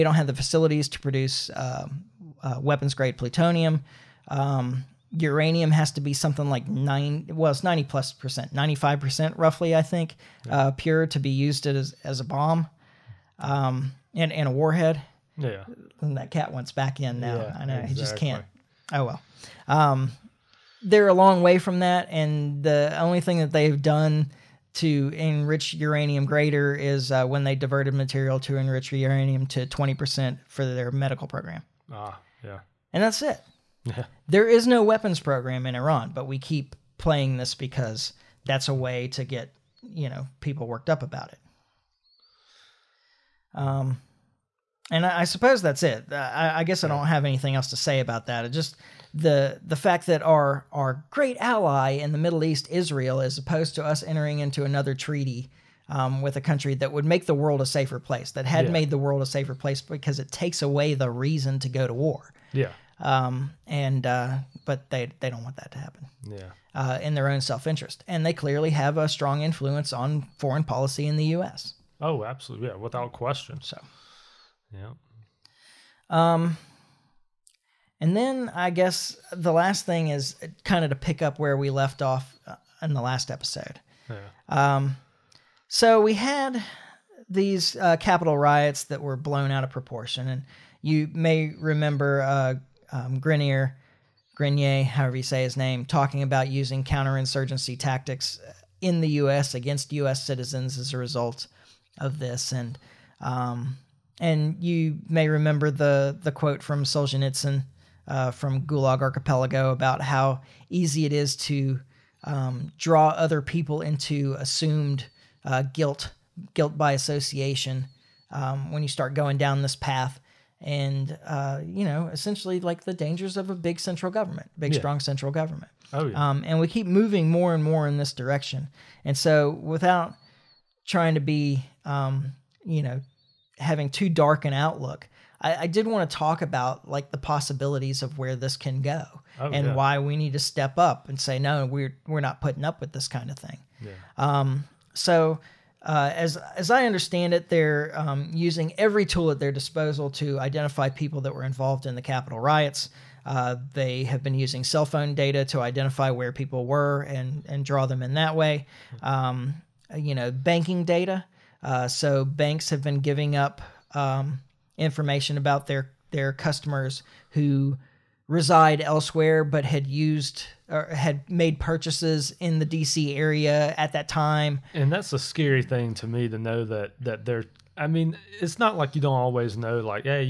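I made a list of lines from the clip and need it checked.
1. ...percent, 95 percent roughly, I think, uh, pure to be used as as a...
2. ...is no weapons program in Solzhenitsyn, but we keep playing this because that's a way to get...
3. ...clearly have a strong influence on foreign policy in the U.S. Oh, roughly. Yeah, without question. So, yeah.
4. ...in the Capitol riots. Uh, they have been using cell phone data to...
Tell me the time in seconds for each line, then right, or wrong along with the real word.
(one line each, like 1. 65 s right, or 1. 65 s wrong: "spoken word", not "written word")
1. 8 s right
2. 34 s wrong: "Iran", not "Solzhenitsyn"
3. 68 s wrong: "absolutely", not "roughly"
4. 151 s right.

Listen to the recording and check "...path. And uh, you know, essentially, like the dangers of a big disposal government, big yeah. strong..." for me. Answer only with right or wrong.
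wrong.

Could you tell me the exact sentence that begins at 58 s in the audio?
made the world a safer place because it takes away the reason to go to war.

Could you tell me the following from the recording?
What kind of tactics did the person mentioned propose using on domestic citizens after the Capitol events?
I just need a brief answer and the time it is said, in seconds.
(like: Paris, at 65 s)
counterinsurgency tactics, at 96 s.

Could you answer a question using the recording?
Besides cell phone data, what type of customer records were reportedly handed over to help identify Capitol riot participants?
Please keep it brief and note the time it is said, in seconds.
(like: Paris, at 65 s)
banking data, at 160 s.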